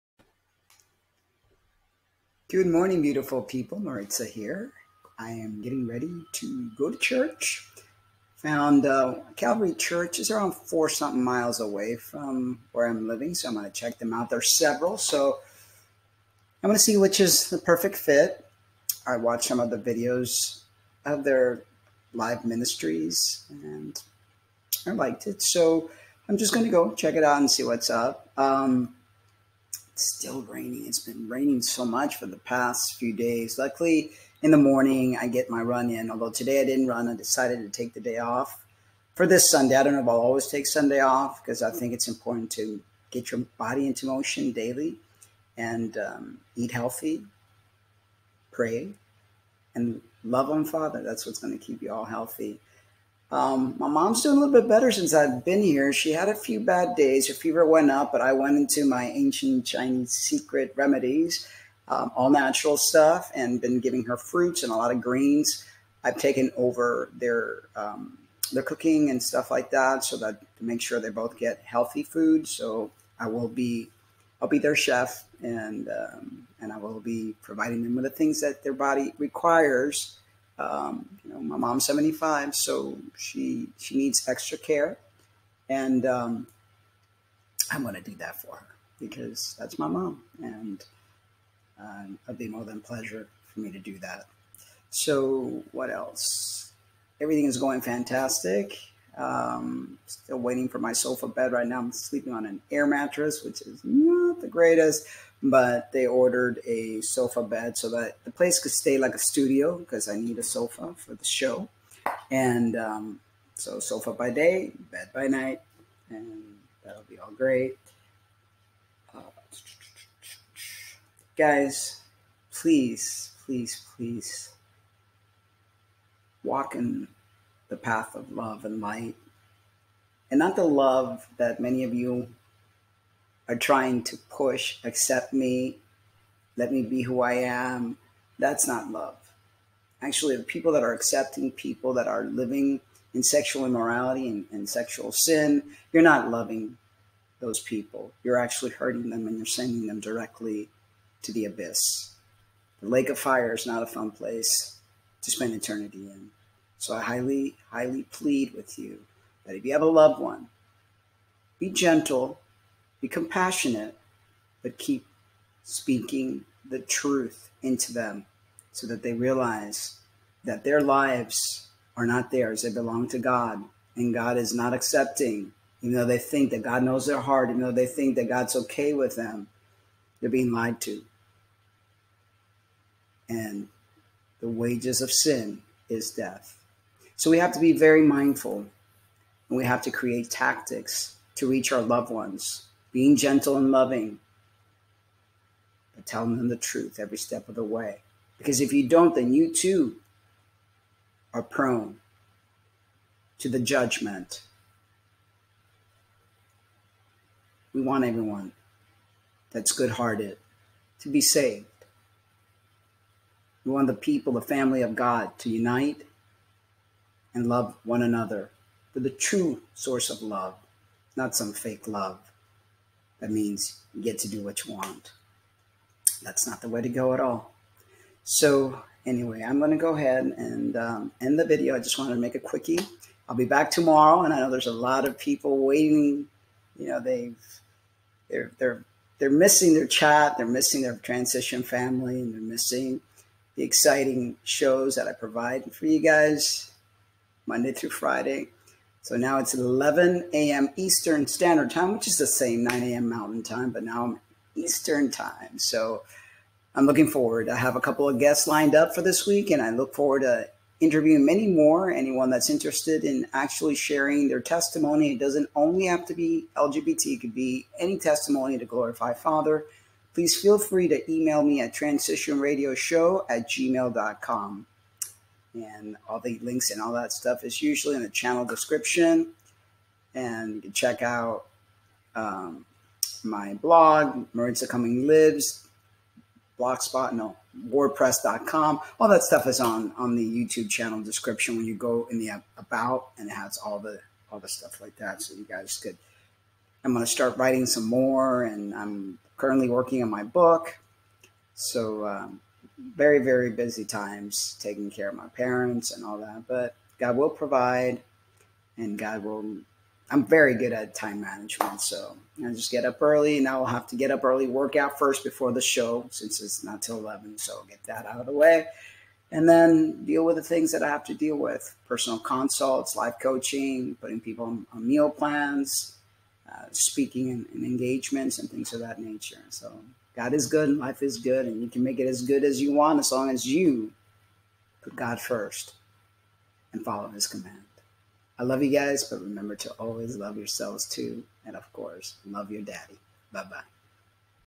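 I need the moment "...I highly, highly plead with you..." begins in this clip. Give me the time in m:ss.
2:36.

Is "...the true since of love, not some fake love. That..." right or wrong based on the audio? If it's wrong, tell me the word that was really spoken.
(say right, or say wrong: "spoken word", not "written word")
wrong: "source", not "since".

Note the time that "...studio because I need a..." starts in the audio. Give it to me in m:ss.
1:49.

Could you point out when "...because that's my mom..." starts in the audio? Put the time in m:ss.
1:28.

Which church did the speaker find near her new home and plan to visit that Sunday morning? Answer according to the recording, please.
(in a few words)
Calvary Church.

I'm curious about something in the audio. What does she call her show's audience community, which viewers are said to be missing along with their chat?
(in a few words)
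transition family.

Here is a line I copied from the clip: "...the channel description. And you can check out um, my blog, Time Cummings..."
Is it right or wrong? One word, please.
wrong.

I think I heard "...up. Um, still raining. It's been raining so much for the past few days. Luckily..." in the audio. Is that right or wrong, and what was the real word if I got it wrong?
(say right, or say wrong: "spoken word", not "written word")
right.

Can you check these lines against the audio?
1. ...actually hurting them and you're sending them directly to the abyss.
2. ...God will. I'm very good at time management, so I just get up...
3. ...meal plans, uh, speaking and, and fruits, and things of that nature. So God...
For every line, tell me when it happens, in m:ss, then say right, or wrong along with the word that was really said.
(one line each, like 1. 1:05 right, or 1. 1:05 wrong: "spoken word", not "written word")
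1. 2:28 right
2. 5:08 right
3. 5:24 wrong: "engagements", not "fruits".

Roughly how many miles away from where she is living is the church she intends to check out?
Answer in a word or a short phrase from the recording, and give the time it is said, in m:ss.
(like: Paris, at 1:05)
4, at 0:10.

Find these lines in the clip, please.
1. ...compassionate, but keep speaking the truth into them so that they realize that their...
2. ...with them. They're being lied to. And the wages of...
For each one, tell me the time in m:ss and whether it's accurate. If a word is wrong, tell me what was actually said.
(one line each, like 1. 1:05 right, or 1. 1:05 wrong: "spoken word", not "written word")
1. 2:43 right
2. 2:58 right.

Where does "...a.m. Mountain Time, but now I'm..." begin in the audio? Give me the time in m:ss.
4:12.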